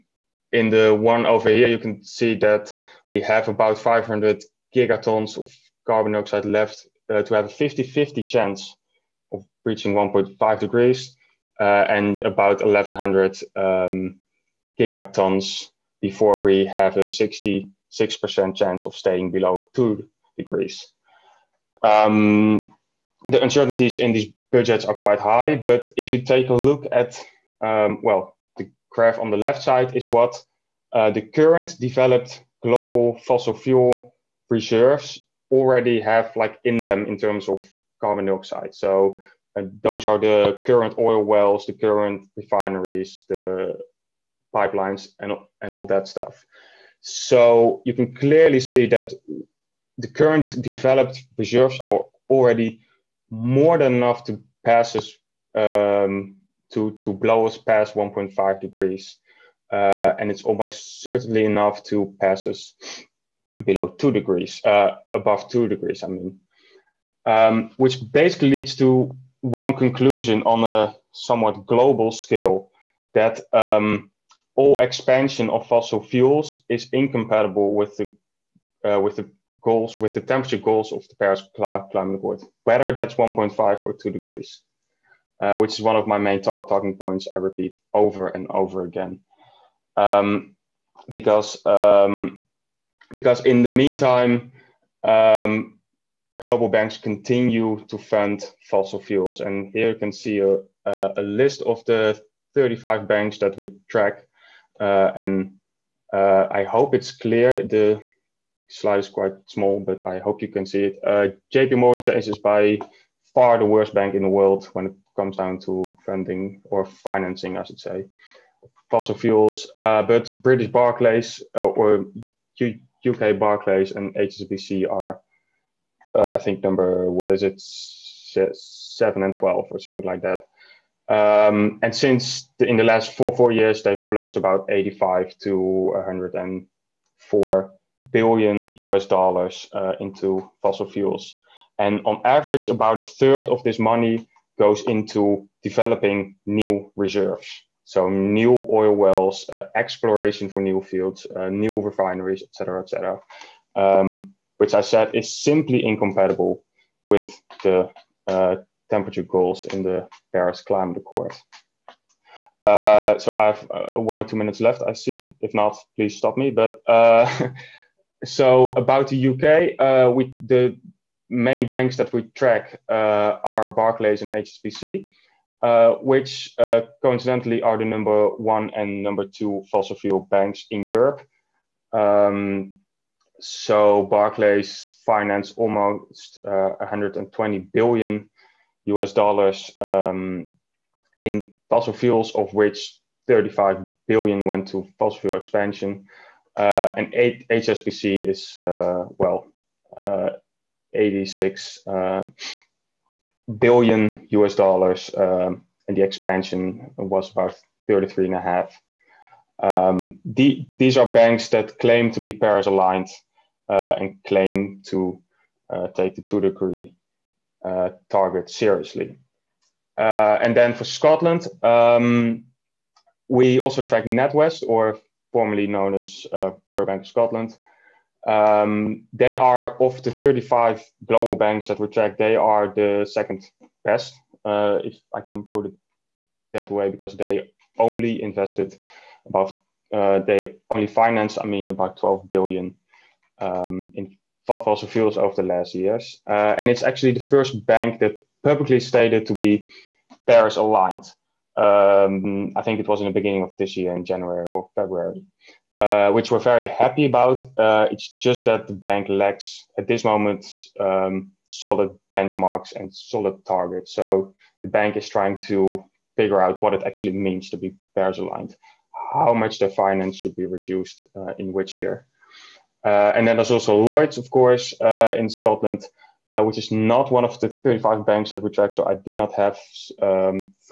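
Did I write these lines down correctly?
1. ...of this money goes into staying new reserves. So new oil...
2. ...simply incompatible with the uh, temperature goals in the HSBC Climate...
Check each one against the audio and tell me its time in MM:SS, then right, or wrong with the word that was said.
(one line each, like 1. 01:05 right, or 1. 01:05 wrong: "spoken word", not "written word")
1. 02:23 wrong: "developing", not "staying"
2. 02:35 wrong: "Paris", not "HSBC".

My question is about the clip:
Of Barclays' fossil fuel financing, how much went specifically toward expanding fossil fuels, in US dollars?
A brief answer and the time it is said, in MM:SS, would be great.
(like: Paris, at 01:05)
35 billion, at 03:13.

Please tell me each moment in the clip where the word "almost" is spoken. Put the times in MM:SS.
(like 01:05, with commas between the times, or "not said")
01:00, 03:05.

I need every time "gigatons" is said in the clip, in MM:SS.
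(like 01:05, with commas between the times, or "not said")
00:04, 00:14.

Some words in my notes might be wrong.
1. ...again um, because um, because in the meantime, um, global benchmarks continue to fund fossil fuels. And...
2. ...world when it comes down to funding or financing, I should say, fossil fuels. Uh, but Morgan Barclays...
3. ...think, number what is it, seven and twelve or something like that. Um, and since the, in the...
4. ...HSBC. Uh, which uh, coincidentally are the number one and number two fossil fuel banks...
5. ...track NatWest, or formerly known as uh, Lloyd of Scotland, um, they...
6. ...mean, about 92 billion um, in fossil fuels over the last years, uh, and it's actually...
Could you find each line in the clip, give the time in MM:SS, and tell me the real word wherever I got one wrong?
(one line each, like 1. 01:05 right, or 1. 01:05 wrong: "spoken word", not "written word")
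1. 01:28 wrong: "banks", not "benchmarks"
2. 01:54 wrong: "British", not "Morgan"
3. 02:06 right
4. 02:54 right
5. 03:43 wrong: "Bank", not "Lloyd"
6. 04:01 wrong: "12", not "92".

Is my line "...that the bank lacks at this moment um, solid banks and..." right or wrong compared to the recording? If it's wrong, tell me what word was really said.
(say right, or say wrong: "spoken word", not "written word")
wrong: "benchmarks", not "banks".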